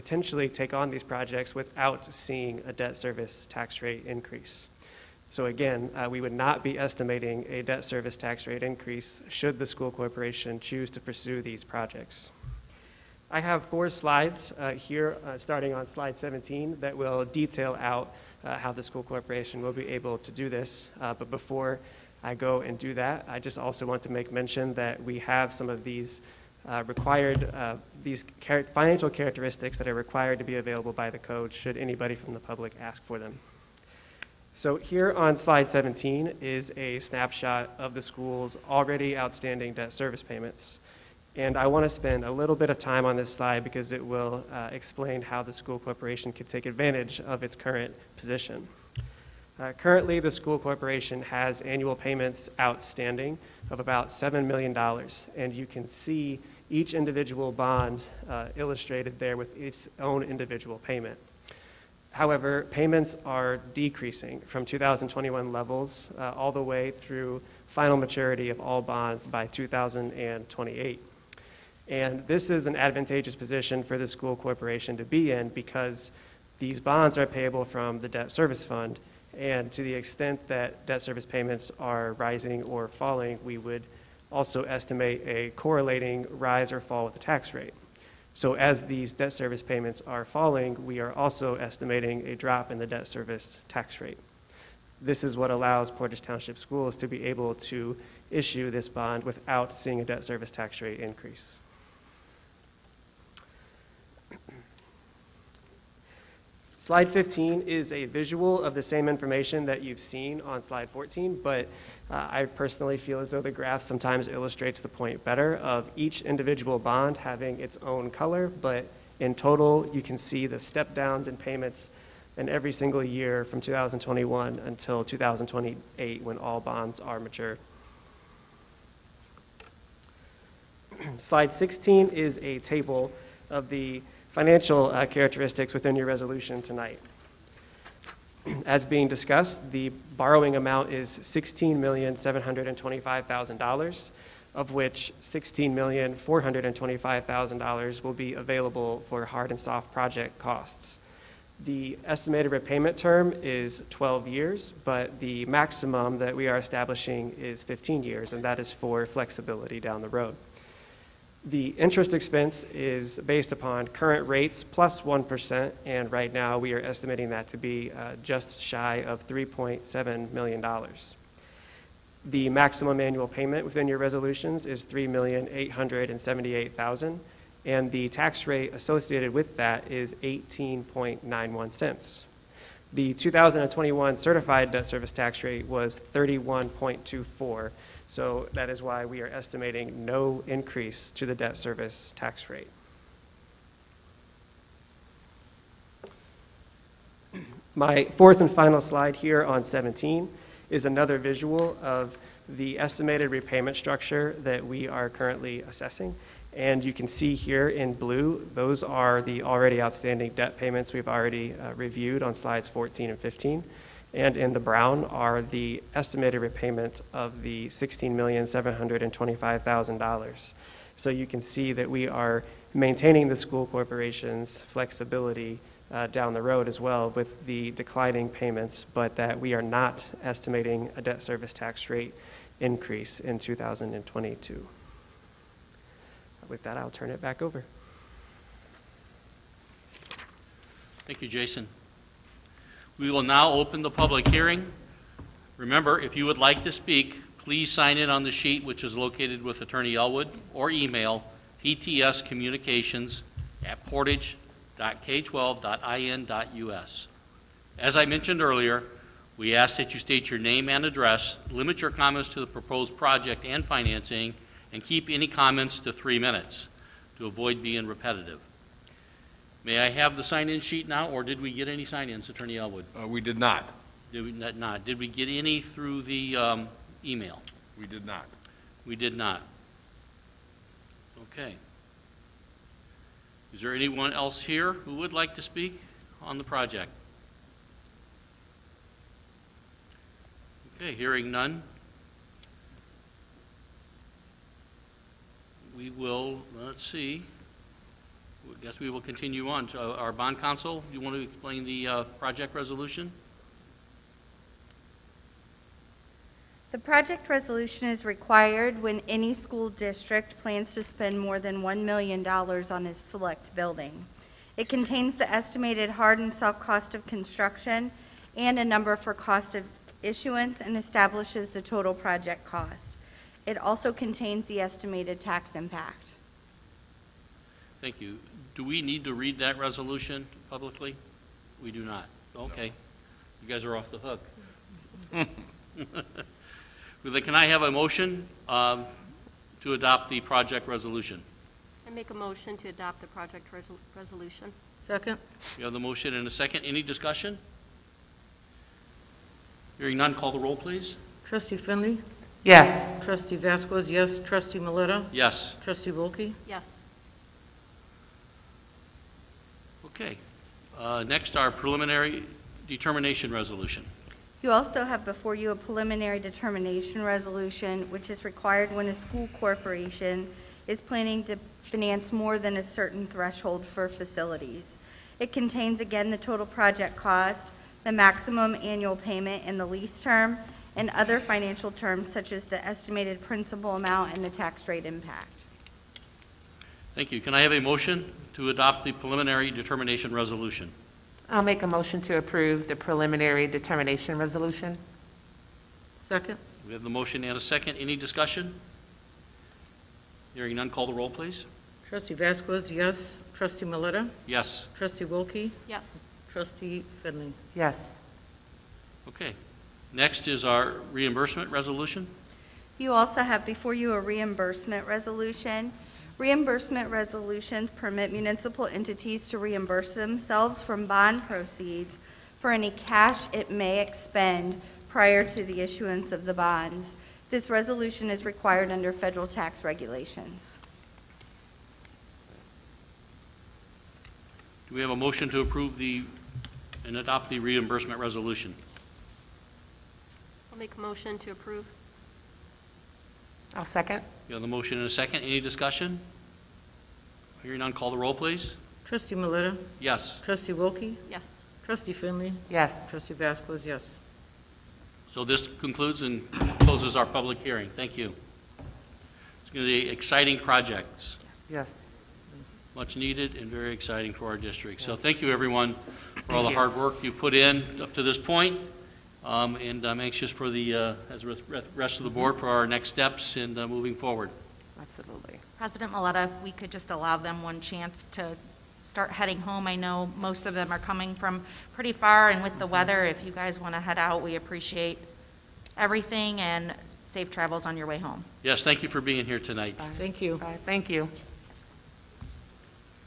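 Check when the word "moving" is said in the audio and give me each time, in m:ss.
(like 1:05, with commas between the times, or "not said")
7:53.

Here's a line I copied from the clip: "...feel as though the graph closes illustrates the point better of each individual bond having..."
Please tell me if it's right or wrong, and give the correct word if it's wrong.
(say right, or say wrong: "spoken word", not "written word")
wrong: "sometimes", not "closes".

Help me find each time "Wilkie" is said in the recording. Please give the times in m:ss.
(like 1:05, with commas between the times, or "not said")
5:55, 6:45, 7:30.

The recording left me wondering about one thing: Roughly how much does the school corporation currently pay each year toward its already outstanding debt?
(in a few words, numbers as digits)
$7 million.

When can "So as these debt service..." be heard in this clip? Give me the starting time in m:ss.
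1:28.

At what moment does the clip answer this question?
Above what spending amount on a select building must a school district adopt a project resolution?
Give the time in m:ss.
5:11.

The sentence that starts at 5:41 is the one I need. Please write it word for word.
I make a motion to adopt the project resol- resolution.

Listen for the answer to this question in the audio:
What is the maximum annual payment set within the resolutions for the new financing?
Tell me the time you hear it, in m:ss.
2:54.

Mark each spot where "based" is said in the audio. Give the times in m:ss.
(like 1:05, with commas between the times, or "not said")
2:43.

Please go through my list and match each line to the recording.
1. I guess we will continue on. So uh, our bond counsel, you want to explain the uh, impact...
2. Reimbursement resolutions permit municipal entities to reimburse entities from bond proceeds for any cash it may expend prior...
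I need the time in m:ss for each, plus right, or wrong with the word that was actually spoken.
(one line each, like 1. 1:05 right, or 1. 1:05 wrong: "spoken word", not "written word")
1. 4:58 wrong: "project", not "impact"
2. 6:56 wrong: "themselves", not "entities".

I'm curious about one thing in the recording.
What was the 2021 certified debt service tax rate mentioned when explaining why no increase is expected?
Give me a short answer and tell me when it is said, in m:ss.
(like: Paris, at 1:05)
31.24, at 3:06.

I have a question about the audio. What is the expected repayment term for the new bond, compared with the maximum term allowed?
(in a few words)
12 years.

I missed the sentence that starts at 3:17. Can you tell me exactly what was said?
My fourth and final slide here on 17 is another visual of the estimated repayment structure that we are currently assessing.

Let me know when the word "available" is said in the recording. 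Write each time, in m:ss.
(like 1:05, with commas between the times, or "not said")
0:30, 2:28.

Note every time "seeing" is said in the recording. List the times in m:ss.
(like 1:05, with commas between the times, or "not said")
0:02, 1:39.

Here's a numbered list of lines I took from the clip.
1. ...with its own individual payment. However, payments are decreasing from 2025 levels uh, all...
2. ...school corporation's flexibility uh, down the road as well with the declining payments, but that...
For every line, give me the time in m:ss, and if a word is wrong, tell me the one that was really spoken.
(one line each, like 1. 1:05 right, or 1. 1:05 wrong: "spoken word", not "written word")
1. 0:59 wrong: "2021", not "2025"
2. 3:43 right.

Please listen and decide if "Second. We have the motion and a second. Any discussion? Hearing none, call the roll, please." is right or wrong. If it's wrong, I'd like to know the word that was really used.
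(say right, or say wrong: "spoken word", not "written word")
right.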